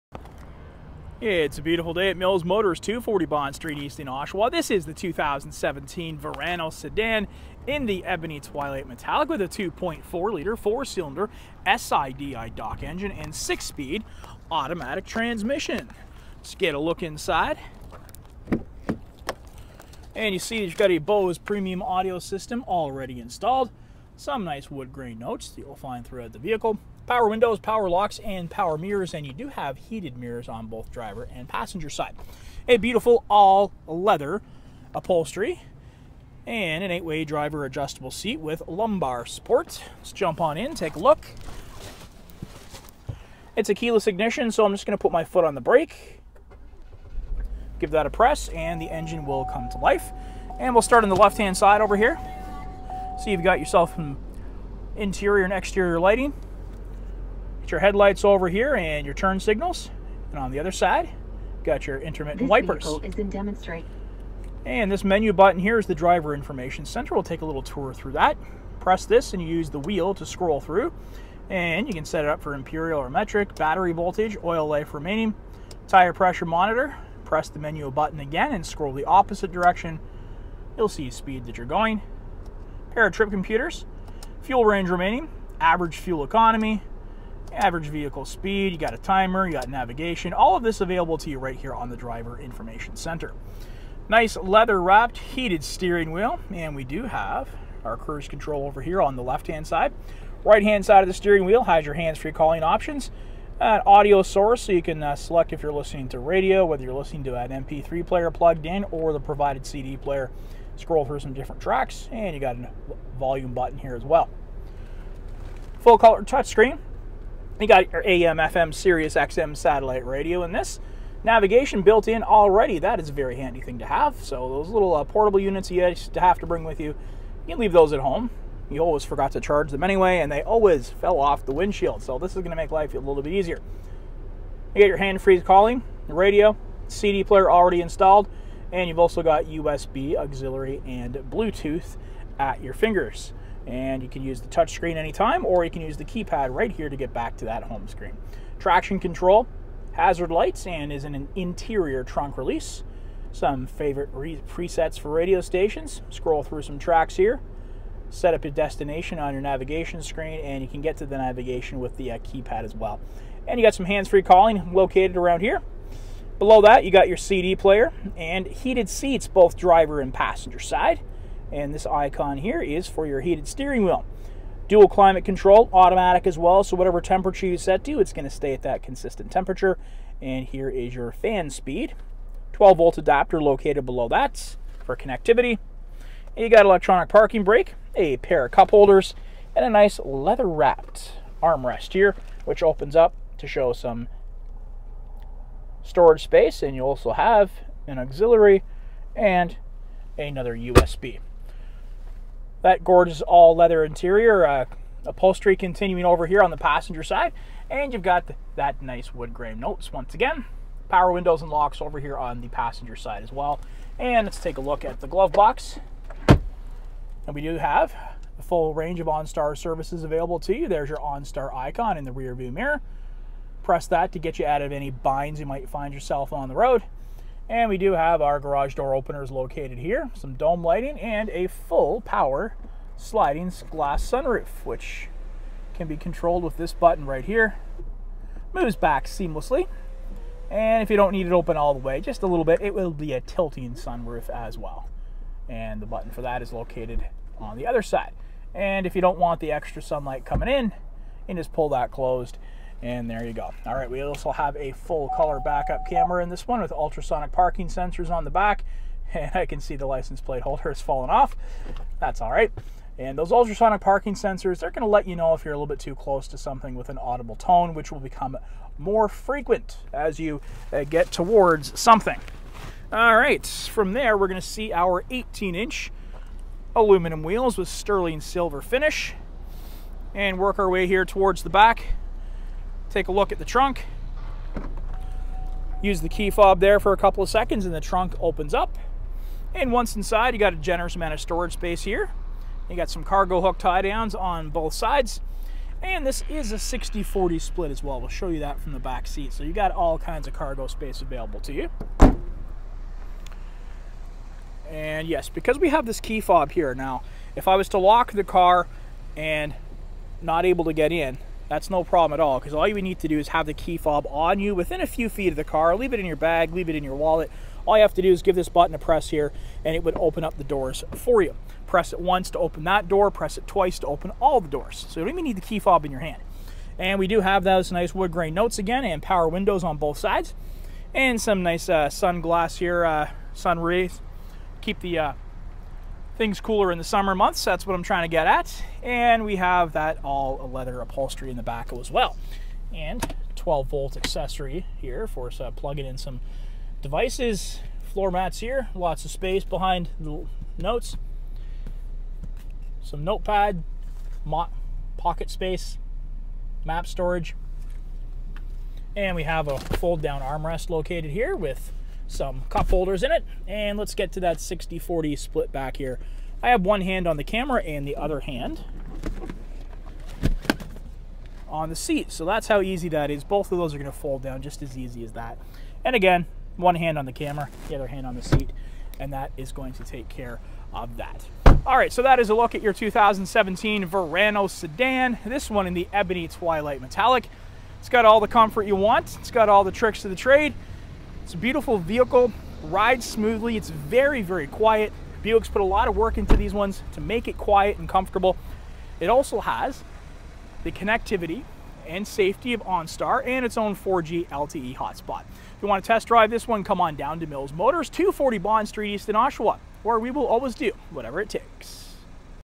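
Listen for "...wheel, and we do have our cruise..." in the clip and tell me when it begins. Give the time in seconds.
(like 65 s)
96 s.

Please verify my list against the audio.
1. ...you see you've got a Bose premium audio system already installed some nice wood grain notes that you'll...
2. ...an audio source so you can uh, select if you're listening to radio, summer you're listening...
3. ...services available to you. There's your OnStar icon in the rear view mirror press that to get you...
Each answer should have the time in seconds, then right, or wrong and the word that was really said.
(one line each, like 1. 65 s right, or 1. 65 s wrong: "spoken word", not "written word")
1. 20 s right
2. 103 s wrong: "whether", not "summer"
3. 219 s right.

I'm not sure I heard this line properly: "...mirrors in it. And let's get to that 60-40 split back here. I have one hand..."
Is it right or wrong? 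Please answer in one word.
wrong.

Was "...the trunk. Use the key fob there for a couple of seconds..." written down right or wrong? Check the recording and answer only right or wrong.
right.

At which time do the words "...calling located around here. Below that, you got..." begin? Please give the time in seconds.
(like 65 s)
164 s.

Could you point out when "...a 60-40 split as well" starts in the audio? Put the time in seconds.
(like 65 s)
296 s.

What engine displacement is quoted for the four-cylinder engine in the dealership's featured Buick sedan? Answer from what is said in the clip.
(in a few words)
2.4 liter.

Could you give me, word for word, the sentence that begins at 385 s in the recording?
This one in the ebony twilight metallic.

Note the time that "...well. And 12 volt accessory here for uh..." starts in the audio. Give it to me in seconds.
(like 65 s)
341 s.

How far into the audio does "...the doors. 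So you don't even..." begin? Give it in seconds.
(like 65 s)
324 s.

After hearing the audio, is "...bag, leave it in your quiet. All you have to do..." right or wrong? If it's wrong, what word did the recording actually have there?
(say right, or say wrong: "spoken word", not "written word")
wrong: "wallet", not "quiet".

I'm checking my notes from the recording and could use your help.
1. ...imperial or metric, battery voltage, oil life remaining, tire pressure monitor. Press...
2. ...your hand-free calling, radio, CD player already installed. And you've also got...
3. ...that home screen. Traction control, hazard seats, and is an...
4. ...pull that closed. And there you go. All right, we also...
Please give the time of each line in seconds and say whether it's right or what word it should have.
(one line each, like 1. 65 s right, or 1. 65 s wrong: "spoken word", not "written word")
1. 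72 s right
2. 134 s right
3. 147 s wrong: "lights", not "seats"
4. 251 s right.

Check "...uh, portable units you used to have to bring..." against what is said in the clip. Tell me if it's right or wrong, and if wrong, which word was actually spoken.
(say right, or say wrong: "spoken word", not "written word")
right.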